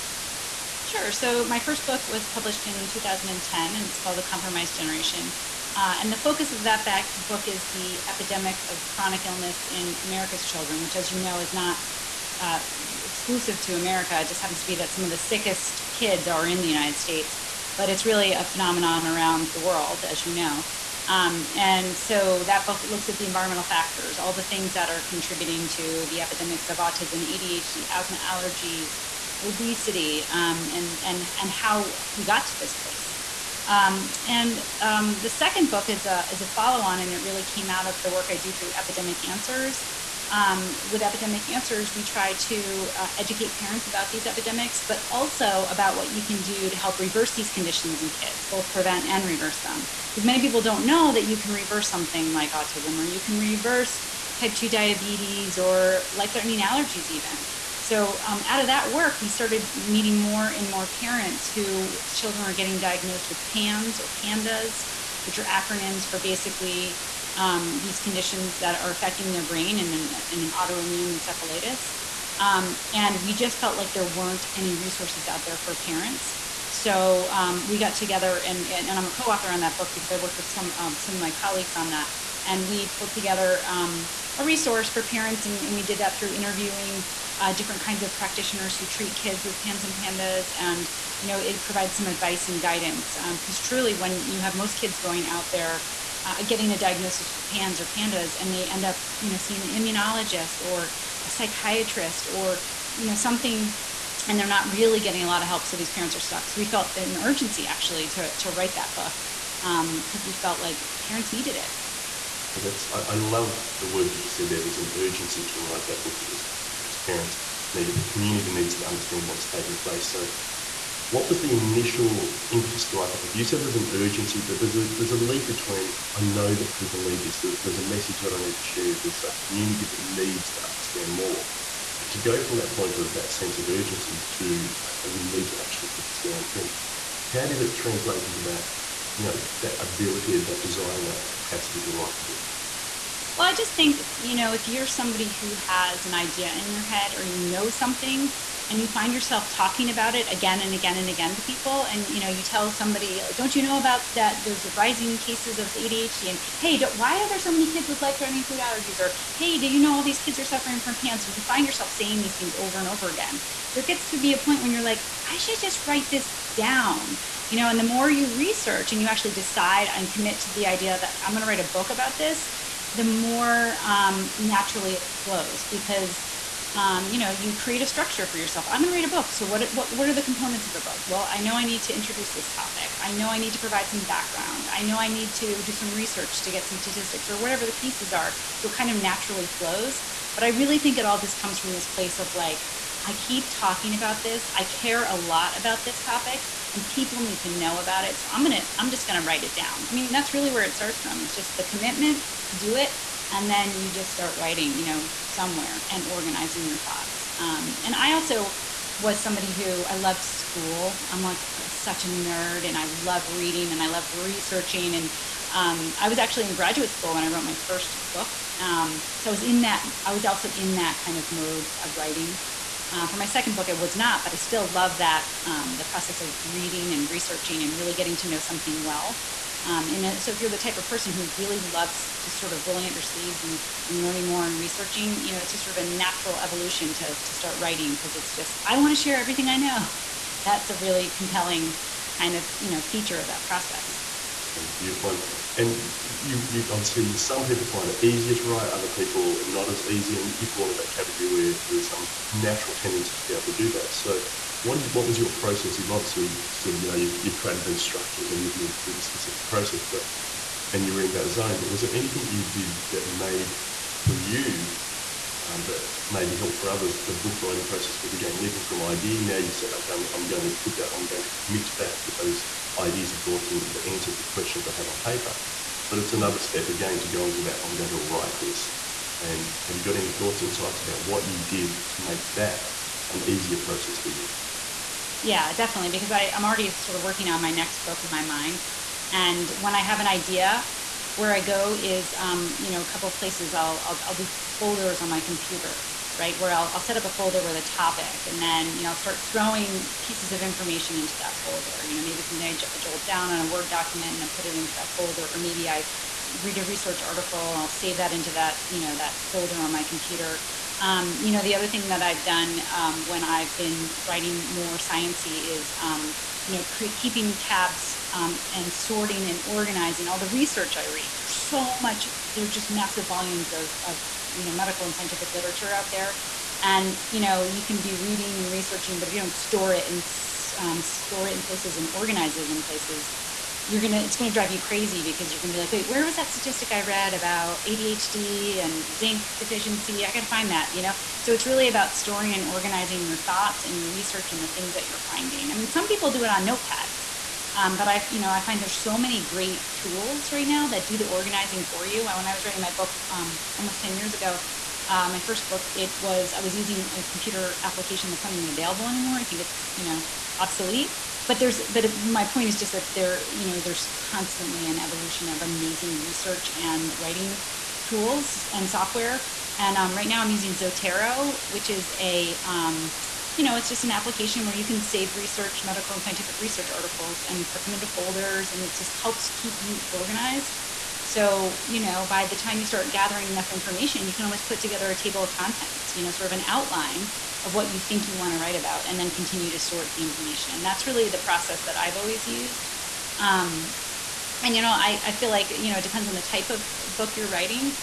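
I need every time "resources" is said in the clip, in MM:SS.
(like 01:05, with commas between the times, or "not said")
01:14, 01:24.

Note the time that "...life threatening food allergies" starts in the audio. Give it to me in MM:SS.
02:38.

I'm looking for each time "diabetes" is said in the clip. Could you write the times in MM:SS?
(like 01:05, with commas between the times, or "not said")
00:54.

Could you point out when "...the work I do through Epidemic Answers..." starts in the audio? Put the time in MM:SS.
00:38.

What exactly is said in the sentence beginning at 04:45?
Because I, I'm already sort of working on my next book in my mind.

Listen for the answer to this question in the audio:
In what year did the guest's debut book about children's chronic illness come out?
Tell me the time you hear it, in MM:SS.
00:02.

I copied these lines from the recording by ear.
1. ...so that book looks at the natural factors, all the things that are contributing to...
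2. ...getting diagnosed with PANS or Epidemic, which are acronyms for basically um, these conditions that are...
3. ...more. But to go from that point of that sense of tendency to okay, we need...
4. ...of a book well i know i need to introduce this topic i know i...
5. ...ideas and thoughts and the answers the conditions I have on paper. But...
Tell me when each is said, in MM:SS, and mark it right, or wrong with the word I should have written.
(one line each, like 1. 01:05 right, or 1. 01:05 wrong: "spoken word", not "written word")
1. 00:21 wrong: "environmental", not "natural"
2. 01:02 wrong: "PANDAS", not "Epidemic"
3. 02:11 wrong: "urgency", not "tendency"
4. 03:00 right
5. 04:32 wrong: "questions", not "conditions".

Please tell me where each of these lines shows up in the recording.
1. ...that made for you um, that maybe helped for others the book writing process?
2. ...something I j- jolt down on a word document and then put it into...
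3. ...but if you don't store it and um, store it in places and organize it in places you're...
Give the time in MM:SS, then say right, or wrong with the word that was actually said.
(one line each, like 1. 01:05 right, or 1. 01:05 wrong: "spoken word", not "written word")
1. 04:22 right
2. 05:02 right
3. 05:28 right.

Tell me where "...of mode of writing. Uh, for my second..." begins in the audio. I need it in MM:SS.
03:41.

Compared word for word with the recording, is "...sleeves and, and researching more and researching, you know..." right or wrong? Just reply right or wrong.
wrong.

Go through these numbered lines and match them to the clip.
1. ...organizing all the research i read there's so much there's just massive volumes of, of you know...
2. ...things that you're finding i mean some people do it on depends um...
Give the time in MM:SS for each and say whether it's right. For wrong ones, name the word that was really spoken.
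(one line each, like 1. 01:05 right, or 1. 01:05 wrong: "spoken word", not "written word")
1. 05:19 right
2. 05:44 wrong: "notepads", not "depends".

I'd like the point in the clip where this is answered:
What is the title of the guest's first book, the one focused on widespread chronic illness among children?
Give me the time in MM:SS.
00:04.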